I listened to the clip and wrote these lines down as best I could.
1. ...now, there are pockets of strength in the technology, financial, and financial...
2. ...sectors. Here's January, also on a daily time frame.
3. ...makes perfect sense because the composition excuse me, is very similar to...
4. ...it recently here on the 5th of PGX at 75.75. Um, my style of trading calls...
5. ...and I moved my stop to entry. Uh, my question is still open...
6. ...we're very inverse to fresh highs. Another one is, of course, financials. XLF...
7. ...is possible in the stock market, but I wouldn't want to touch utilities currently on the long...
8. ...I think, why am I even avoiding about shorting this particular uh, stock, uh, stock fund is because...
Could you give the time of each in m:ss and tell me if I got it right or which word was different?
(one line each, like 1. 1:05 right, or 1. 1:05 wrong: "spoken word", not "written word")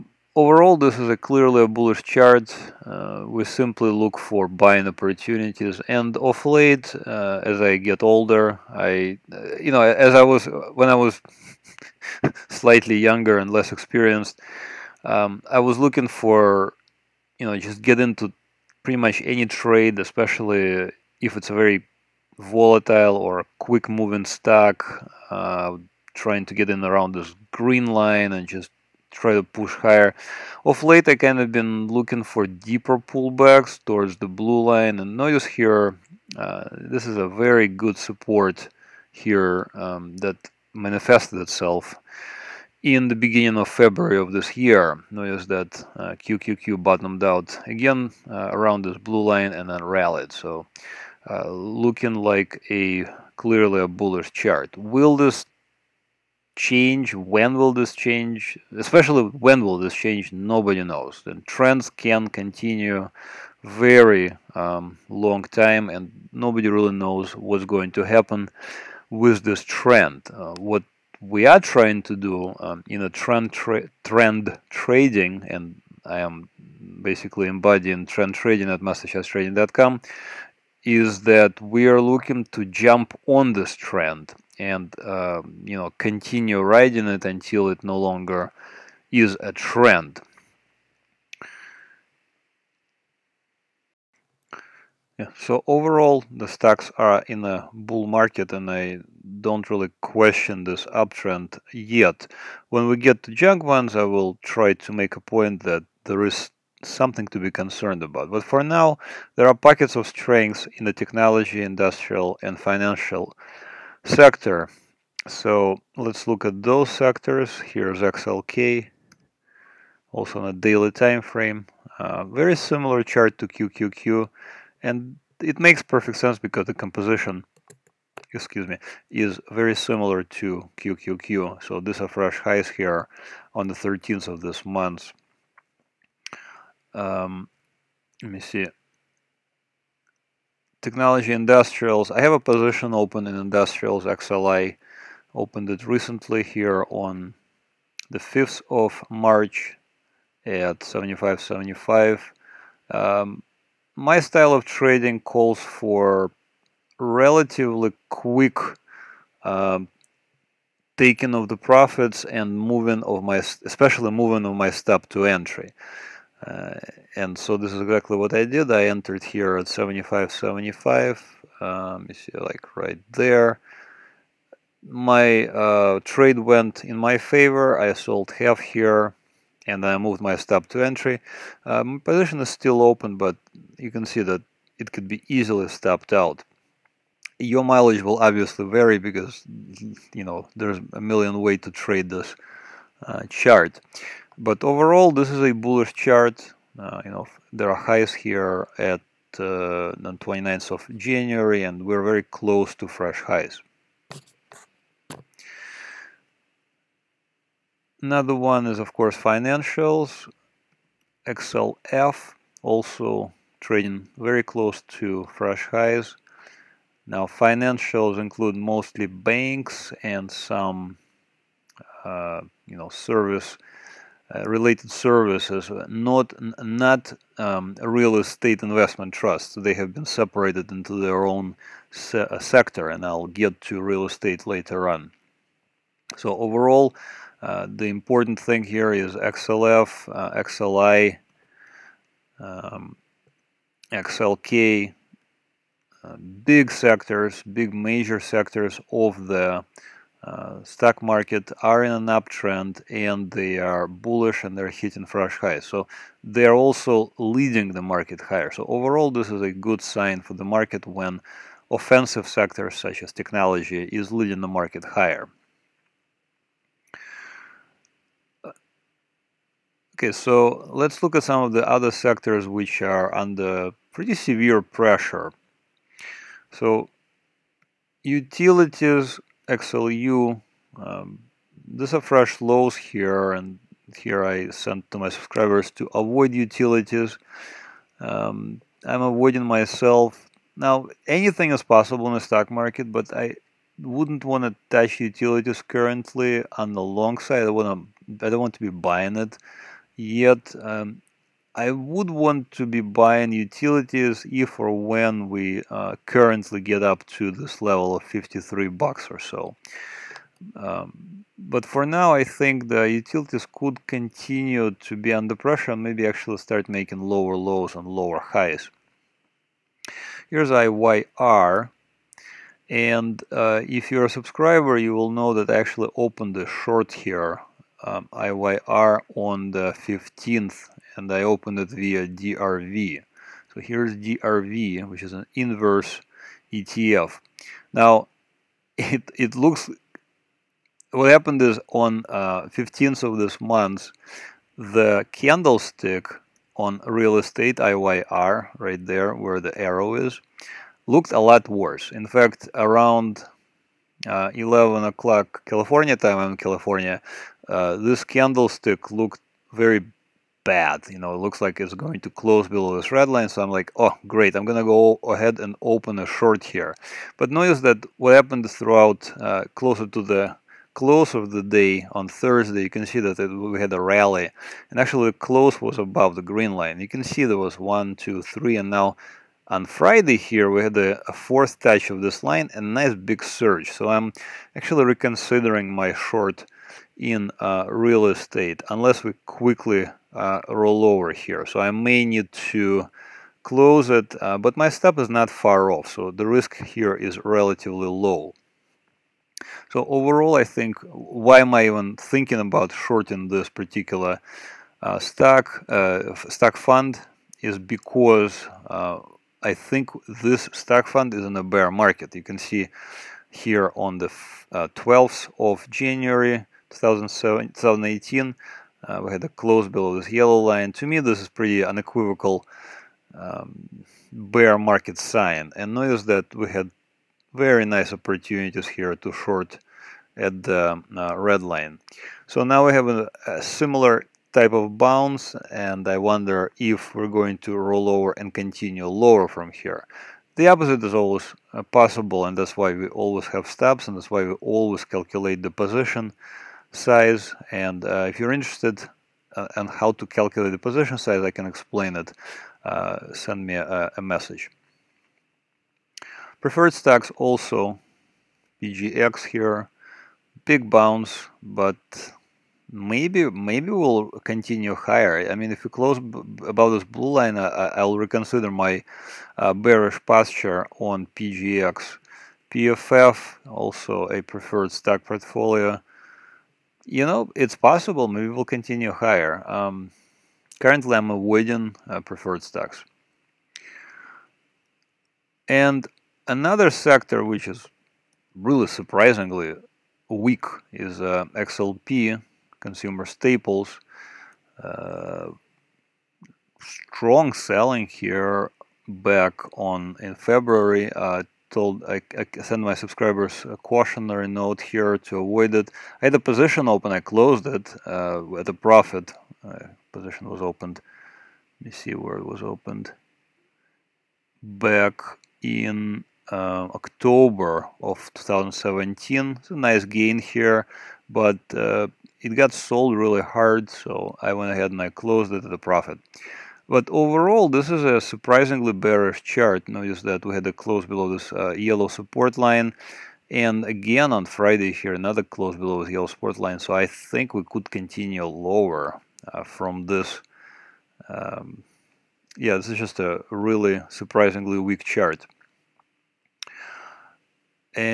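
1. 1:48 wrong: "industrial", not "financial"
2. 1:56 wrong: "XLK", not "January"
3. 2:05 right
4. 2:25 wrong: "March", not "PGX"
5. 2:59 wrong: "position", not "question"
6. 3:21 wrong: "close", not "inverse"
7. 4:51 right
8. 6:40 wrong: "thinking", not "avoiding".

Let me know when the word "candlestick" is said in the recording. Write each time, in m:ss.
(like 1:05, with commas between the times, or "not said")
5:45, 5:58.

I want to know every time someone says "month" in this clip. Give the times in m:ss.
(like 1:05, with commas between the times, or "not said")
2:14, 5:43.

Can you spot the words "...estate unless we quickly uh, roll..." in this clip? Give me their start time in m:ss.
6:28.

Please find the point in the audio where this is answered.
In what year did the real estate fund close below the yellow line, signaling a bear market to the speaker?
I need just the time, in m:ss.
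6:56.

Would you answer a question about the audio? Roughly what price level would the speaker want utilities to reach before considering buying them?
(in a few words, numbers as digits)
53.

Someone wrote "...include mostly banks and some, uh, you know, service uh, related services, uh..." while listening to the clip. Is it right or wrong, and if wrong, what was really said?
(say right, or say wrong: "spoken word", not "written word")
right.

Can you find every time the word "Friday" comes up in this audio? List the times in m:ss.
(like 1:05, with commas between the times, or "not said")
6:19, 8:54.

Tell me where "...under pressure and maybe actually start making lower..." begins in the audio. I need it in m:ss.
5:15.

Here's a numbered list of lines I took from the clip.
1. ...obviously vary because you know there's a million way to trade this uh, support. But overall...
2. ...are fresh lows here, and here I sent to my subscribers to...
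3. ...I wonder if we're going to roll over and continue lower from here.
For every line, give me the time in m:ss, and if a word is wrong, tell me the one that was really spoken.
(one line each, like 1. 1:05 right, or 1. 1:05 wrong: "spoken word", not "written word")
1. 3:08 wrong: "chart", not "support"
2. 4:41 right
3. 7:15 right.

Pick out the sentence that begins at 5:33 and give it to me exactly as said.
So here's DRV, which is an inverse ETF.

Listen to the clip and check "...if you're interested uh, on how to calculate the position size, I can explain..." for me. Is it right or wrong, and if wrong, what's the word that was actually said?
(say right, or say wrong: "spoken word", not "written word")
right.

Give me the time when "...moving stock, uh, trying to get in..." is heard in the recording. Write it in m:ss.
0:23.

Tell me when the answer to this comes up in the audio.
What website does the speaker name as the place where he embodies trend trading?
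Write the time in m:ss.
1:18.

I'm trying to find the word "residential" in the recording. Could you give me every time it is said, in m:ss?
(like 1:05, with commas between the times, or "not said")
not said.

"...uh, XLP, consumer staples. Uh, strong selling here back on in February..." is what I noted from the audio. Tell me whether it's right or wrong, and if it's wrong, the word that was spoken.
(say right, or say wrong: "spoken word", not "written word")
right.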